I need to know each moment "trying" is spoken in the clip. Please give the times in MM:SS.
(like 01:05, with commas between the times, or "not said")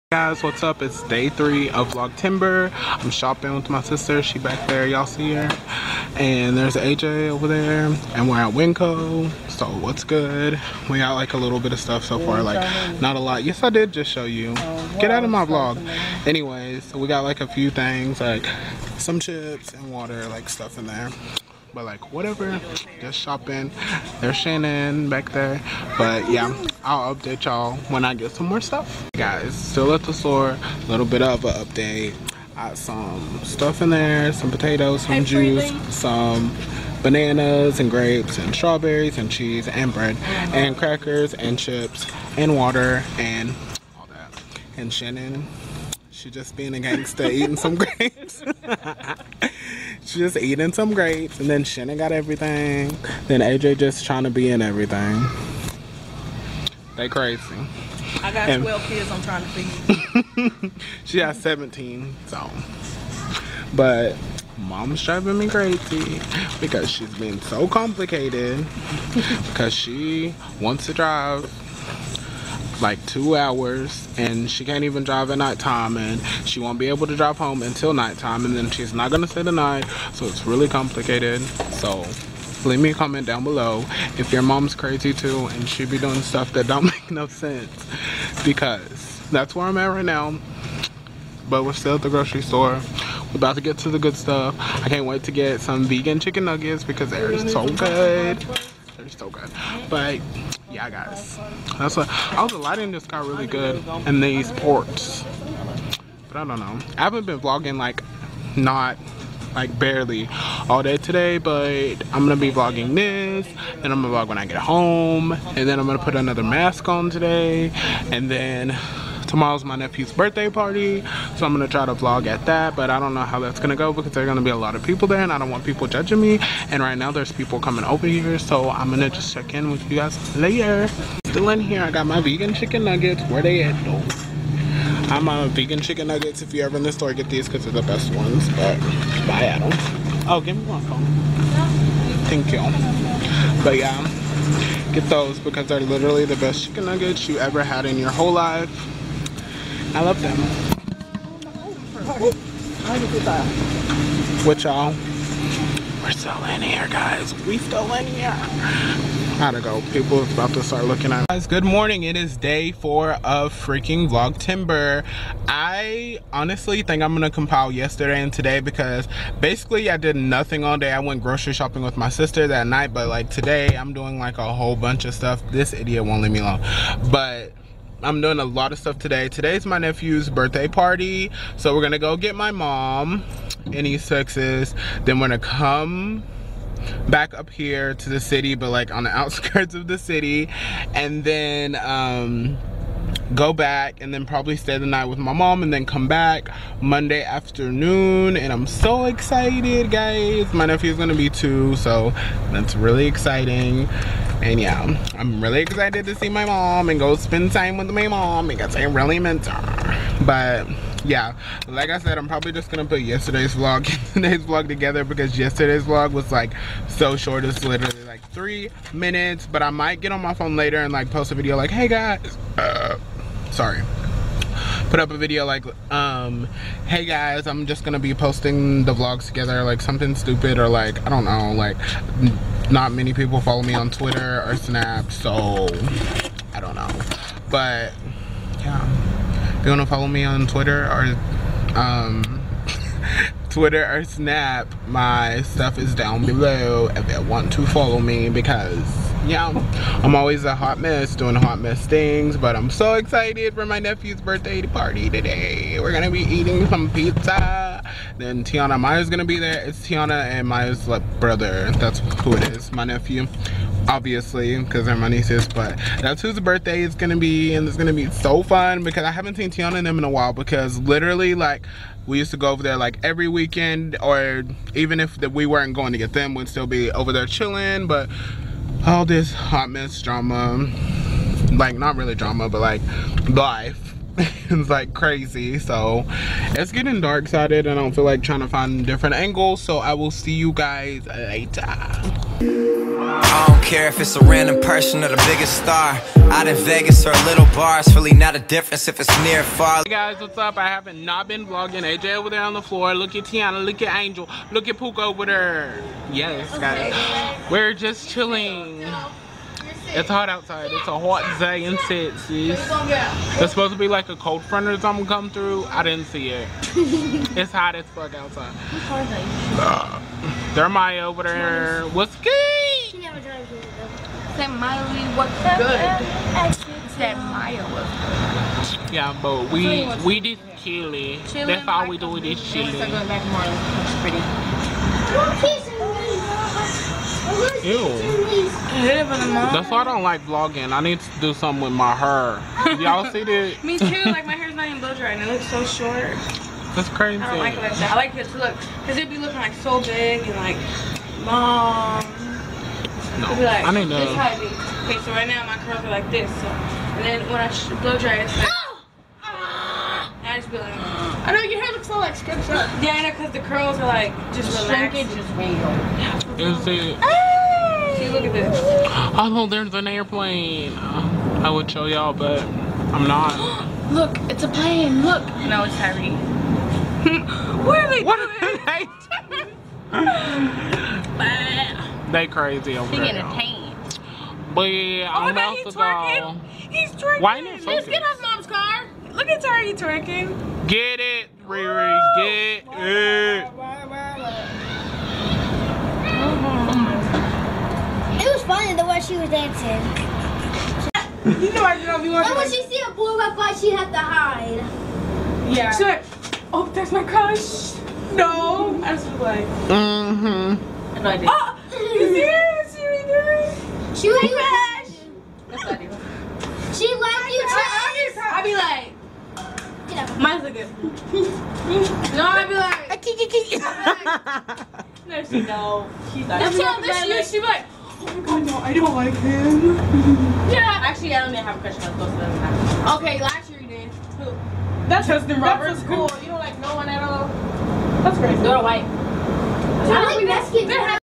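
00:54, 00:59, 04:48.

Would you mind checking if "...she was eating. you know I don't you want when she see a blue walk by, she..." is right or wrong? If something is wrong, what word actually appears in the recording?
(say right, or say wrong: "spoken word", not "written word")
wrong: "dancing", not "eating".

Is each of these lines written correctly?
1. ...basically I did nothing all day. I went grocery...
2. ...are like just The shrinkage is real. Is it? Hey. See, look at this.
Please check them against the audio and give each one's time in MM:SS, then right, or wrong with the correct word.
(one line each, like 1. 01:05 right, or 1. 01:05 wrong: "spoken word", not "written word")
1. 02:49 right
2. 06:03 right.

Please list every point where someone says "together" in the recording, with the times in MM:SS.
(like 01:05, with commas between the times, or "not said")
03:34, 03:49.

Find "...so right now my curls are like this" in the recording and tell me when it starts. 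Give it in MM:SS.
05:55.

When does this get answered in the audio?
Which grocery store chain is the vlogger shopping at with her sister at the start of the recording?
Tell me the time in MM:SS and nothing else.
00:08.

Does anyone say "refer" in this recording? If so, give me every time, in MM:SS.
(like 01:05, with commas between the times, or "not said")
not said.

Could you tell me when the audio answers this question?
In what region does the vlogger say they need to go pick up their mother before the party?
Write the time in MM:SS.
03:03.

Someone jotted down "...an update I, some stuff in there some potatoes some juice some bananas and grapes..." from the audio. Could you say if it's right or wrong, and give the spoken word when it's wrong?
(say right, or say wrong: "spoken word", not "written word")
right.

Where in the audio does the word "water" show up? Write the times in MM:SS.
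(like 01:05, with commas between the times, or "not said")
00:19, 00:42.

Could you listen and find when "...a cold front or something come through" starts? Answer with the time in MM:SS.
05:14.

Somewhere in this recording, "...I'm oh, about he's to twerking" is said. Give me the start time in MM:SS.
06:25.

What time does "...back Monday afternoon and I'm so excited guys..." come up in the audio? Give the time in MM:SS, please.
03:16.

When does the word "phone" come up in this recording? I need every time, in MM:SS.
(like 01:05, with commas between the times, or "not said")
02:20, 03:40.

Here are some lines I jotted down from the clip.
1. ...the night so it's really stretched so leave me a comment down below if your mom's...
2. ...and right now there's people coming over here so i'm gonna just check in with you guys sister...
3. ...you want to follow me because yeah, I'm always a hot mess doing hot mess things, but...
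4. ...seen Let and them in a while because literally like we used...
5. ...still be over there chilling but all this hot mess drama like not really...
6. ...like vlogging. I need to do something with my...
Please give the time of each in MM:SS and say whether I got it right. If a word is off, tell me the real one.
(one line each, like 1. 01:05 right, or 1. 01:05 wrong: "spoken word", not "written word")
1. 01:19 wrong: "complicated", not "stretched"
2. 02:06 wrong: "later", not "sister"
3. 04:07 right
4. 04:29 wrong: "Tiana", not "Let"
5. 04:36 right
6. 05:40 right.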